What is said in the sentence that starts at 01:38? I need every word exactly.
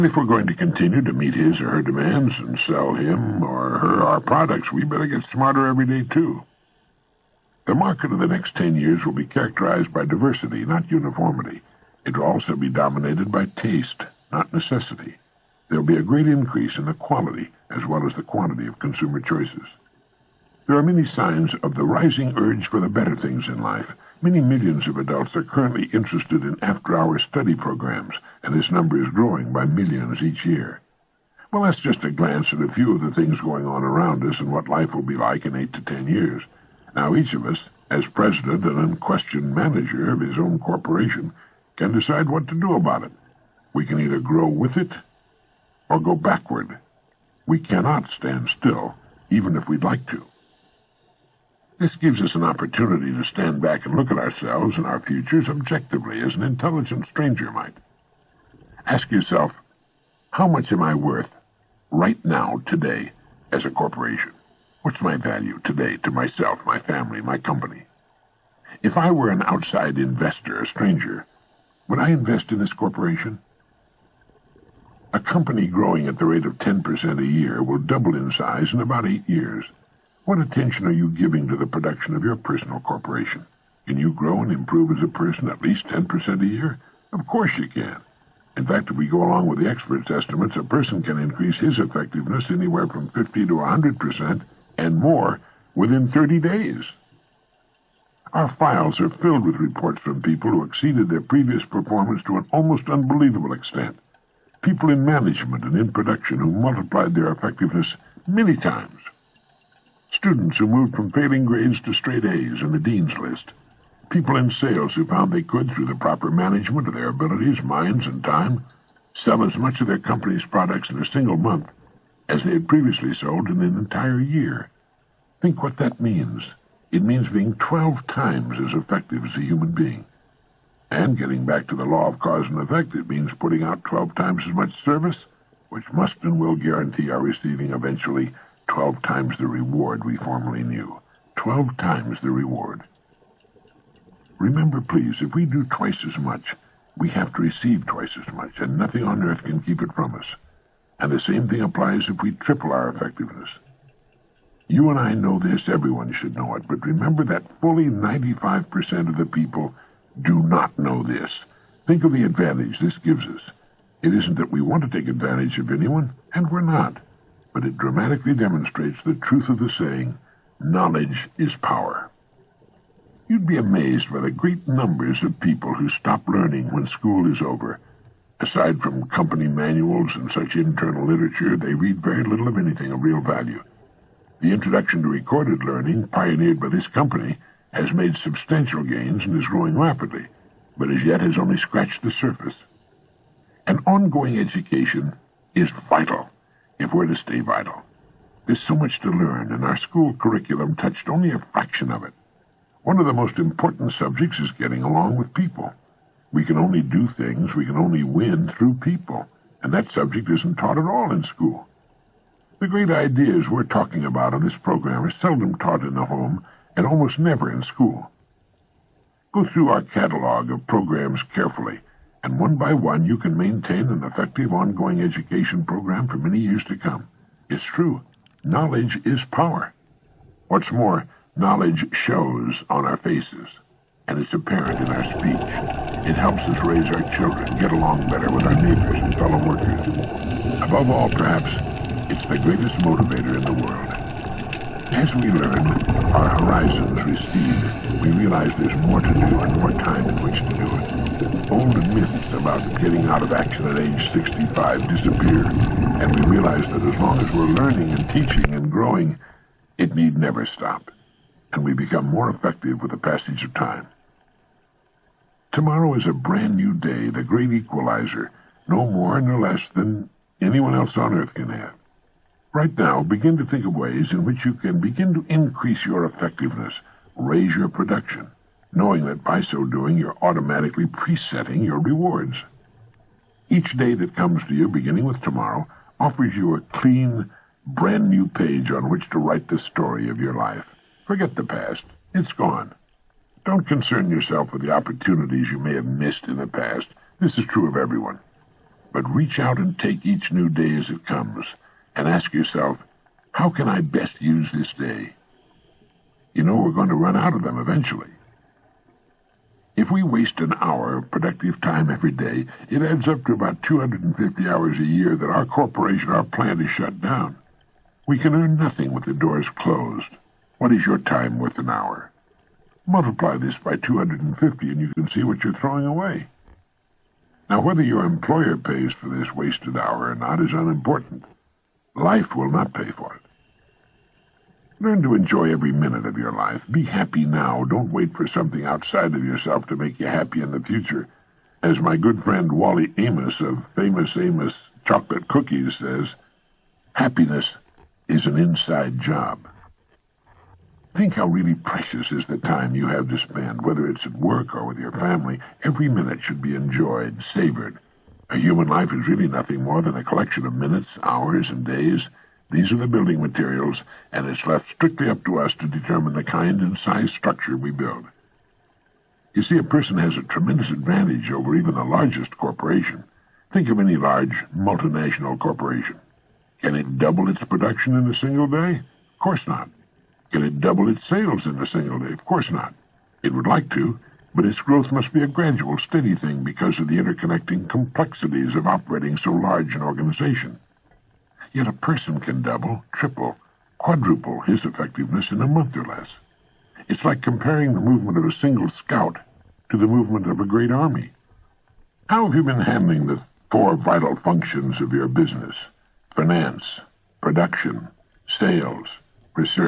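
Our files are filled with reports from people who exceeded their previous performance to an almost unbelievable extent.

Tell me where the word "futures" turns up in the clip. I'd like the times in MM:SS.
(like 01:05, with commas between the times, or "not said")
00:55, 05:40.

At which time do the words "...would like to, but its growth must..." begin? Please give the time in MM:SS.
06:23.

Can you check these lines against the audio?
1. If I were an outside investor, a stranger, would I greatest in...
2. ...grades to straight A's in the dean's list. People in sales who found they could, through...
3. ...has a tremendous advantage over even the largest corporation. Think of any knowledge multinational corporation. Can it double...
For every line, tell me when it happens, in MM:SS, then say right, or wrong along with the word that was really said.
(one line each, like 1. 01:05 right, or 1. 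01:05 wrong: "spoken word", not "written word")
1. 01:08 wrong: "invest", not "greatest"
2. 01:51 right
3. 06:09 wrong: "large", not "knowledge".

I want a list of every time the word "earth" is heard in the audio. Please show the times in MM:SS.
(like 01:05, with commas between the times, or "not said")
02:29, 04:31.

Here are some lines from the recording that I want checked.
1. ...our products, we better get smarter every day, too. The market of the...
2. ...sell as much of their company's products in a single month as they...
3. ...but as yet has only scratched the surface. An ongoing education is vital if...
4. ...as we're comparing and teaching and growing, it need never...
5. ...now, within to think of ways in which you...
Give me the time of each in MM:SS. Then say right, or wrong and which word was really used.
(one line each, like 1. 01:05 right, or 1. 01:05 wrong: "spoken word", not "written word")
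1. 00:04 right
2. 01:59 right
3. 03:10 right
4. 04:17 wrong: "learning", not "comparing"
5. 04:32 wrong: "begin", not "within".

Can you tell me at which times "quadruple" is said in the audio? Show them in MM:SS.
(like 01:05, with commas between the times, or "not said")
06:33.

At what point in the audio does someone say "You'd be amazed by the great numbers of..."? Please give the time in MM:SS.
02:53.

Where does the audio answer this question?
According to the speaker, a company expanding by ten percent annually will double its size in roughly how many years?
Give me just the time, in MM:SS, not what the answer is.
01:18.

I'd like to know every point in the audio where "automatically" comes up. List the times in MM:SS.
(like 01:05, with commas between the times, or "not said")
04:40.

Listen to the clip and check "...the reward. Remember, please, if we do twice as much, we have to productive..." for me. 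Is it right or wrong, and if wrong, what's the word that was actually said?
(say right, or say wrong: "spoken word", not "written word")
wrong: "receive", not "productive".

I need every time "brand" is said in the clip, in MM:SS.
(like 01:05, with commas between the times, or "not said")
04:26, 04:47.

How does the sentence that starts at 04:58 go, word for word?
But reach out and take each new day as it comes and ask yourself, how can I best use this day?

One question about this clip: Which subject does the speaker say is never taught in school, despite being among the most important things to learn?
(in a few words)
Getting along with people.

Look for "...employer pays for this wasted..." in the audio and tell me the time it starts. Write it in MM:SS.
05:28.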